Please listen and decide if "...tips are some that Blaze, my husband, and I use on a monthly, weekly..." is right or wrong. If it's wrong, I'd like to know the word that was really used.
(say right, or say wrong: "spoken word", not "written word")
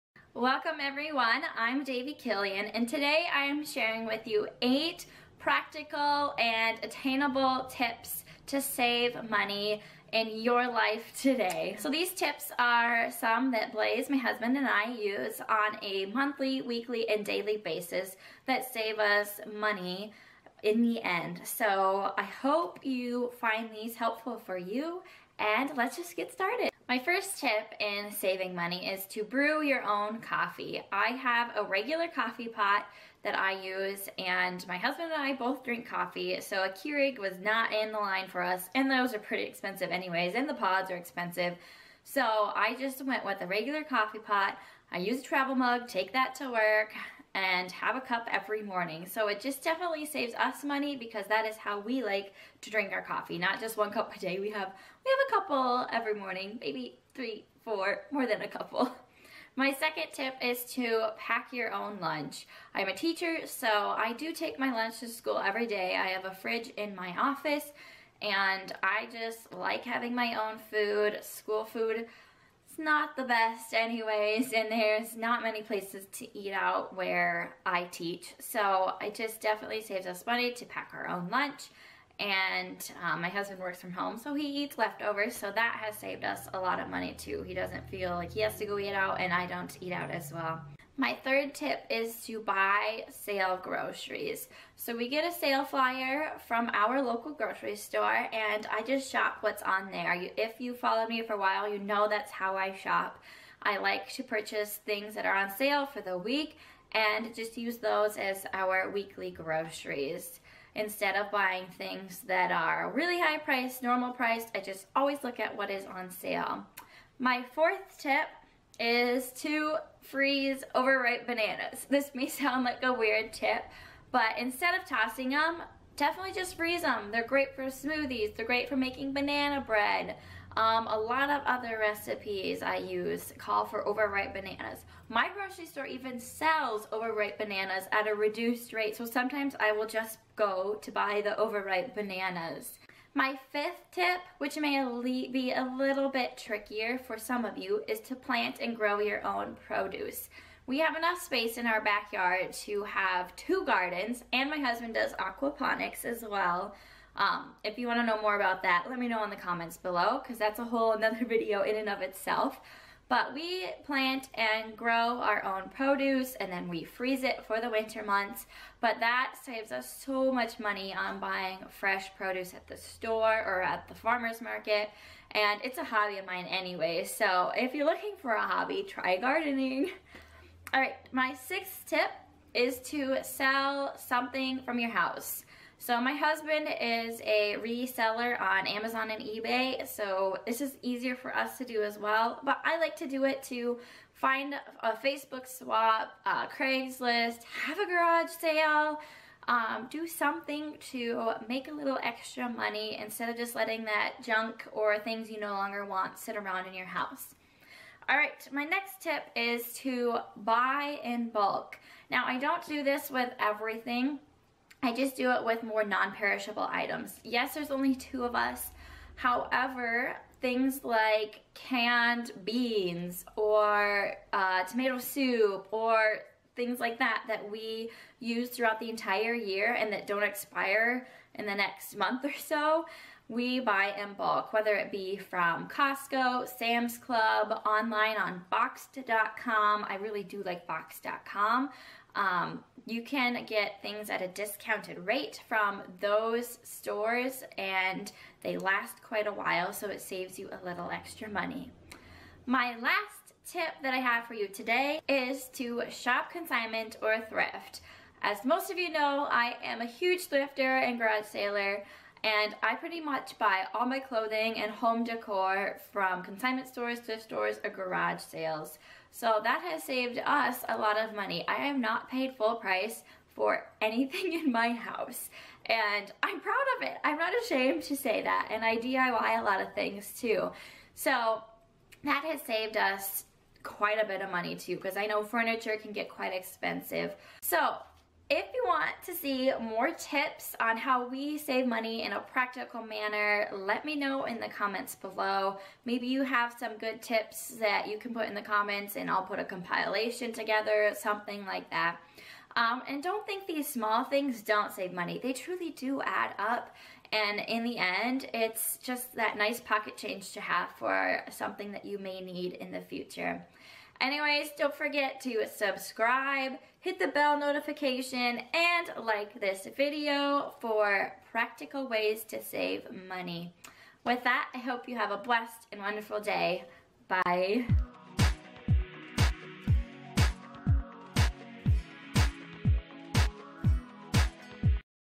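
right.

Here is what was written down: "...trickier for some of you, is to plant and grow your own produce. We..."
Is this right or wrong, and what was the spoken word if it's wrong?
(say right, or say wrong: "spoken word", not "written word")
right.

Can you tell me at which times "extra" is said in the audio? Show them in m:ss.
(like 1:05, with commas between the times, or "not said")
3:22, 4:10.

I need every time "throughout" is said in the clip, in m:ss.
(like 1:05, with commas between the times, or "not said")
3:48.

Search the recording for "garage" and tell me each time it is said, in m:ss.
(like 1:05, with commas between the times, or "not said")
3:17, 4:20, 4:27.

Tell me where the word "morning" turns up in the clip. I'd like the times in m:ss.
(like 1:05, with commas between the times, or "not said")
0:48, 0:56.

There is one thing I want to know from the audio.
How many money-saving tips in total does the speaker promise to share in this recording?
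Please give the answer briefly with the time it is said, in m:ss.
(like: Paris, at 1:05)
8, at 0:04.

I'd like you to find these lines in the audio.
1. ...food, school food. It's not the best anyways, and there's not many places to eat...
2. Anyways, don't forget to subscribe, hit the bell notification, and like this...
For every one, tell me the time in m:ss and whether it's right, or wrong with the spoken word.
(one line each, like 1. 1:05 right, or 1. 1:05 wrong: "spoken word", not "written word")
1. 1:10 right
2. 5:14 right.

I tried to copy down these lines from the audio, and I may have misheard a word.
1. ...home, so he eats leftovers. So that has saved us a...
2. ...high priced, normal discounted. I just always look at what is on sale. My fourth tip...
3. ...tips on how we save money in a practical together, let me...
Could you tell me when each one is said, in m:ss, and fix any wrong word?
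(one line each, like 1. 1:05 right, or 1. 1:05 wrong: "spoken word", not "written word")
1. 1:23 right
2. 1:53 wrong: "priced", not "discounted"
3. 4:49 wrong: "manner", not "together".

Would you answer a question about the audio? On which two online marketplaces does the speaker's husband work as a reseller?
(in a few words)
Amazon and eBay.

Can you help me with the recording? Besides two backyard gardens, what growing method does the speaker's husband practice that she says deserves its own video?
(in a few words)
Aquaponics.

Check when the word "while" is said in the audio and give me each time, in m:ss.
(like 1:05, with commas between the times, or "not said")
1:41, 4:09.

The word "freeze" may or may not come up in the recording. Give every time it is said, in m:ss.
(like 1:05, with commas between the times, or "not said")
2:00, 2:06, 2:46.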